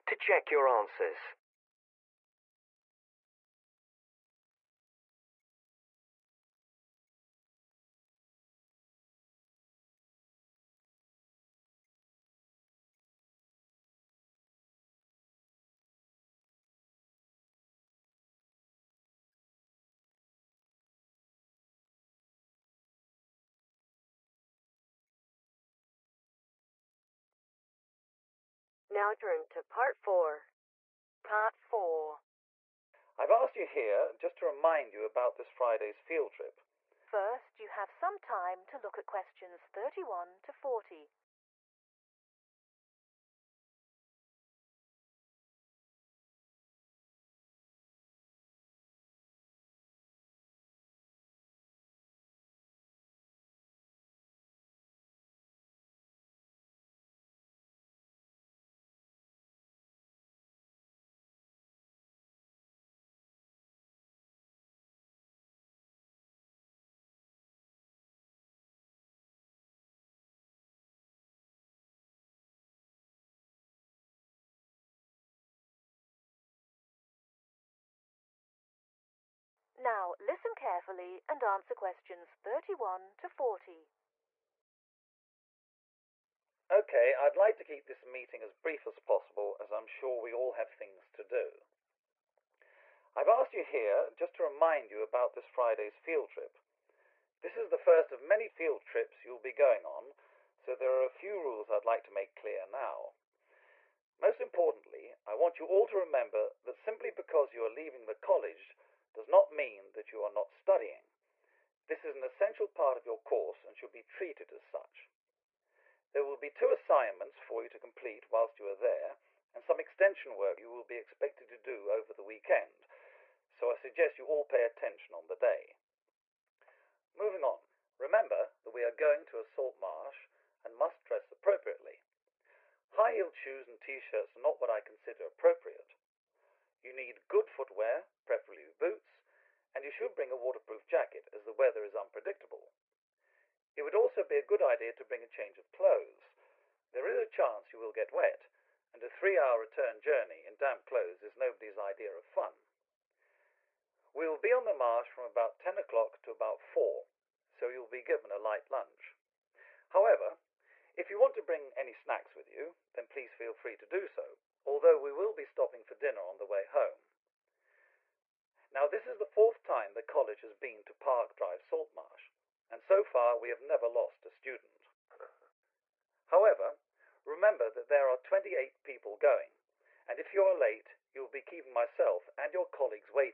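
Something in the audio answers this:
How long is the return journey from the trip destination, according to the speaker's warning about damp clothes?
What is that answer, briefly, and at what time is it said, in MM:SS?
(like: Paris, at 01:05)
3 hours, at 02:29.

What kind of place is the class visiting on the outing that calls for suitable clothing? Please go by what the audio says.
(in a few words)
salt marsh.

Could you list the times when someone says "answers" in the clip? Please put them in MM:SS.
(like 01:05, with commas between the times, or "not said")
00:00, 01:21.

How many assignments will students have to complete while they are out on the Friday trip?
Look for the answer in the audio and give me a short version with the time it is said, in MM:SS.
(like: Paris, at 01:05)
2, at 01:56.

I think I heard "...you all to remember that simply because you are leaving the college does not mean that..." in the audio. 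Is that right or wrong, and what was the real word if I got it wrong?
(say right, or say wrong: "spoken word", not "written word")
right.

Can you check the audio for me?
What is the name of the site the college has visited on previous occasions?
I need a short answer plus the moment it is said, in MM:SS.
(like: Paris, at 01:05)
Park Drive Saltmarsh, at 02:50.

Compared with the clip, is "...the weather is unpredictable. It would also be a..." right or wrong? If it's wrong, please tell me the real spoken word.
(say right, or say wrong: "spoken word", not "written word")
right.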